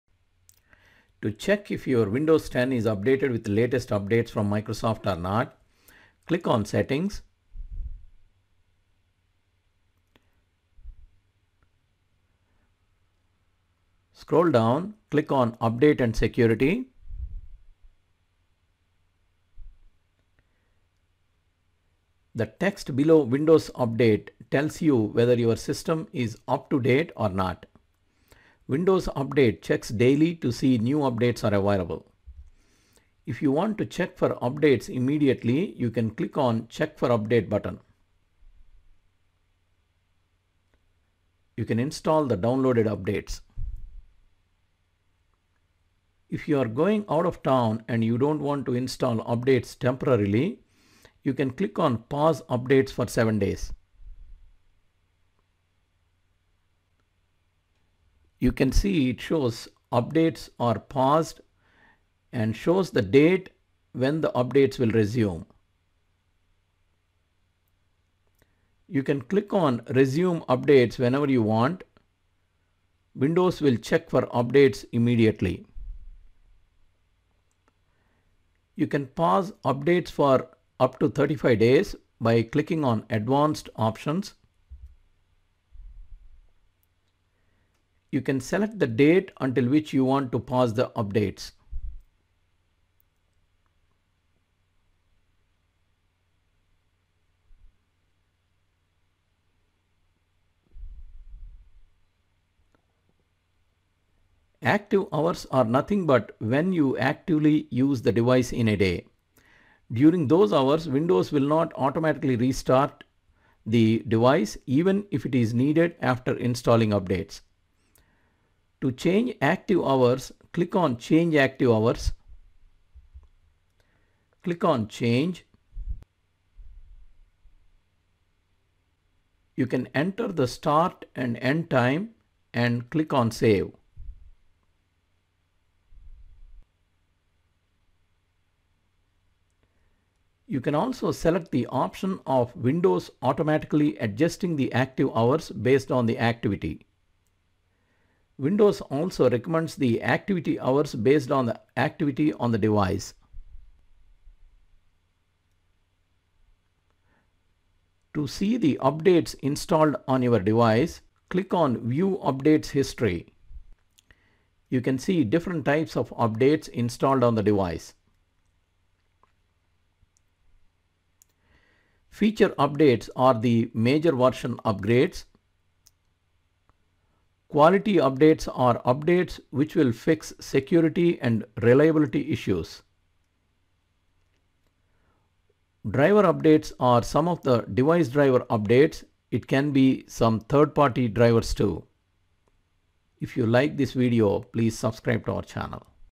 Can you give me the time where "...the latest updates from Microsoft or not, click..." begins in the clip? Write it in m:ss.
0:03.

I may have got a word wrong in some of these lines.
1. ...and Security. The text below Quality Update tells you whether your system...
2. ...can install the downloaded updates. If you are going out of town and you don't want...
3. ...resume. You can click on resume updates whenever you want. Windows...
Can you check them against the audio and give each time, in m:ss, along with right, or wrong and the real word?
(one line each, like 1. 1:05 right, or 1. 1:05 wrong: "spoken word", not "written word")
1. 0:16 wrong: "Windows", not "Quality"
2. 0:41 right
3. 1:04 right.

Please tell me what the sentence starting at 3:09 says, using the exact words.
It can be some third-party drivers too.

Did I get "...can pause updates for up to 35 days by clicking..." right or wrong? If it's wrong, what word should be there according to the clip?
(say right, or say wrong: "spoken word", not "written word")
right.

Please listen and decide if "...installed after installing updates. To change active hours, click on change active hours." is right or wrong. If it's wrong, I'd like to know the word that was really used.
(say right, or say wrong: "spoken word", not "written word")
wrong: "needed", not "installed".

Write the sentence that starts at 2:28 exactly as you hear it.
Windows also recommends the activity hours based on the activity on the device.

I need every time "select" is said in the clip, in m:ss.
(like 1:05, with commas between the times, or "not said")
1:28, 2:21.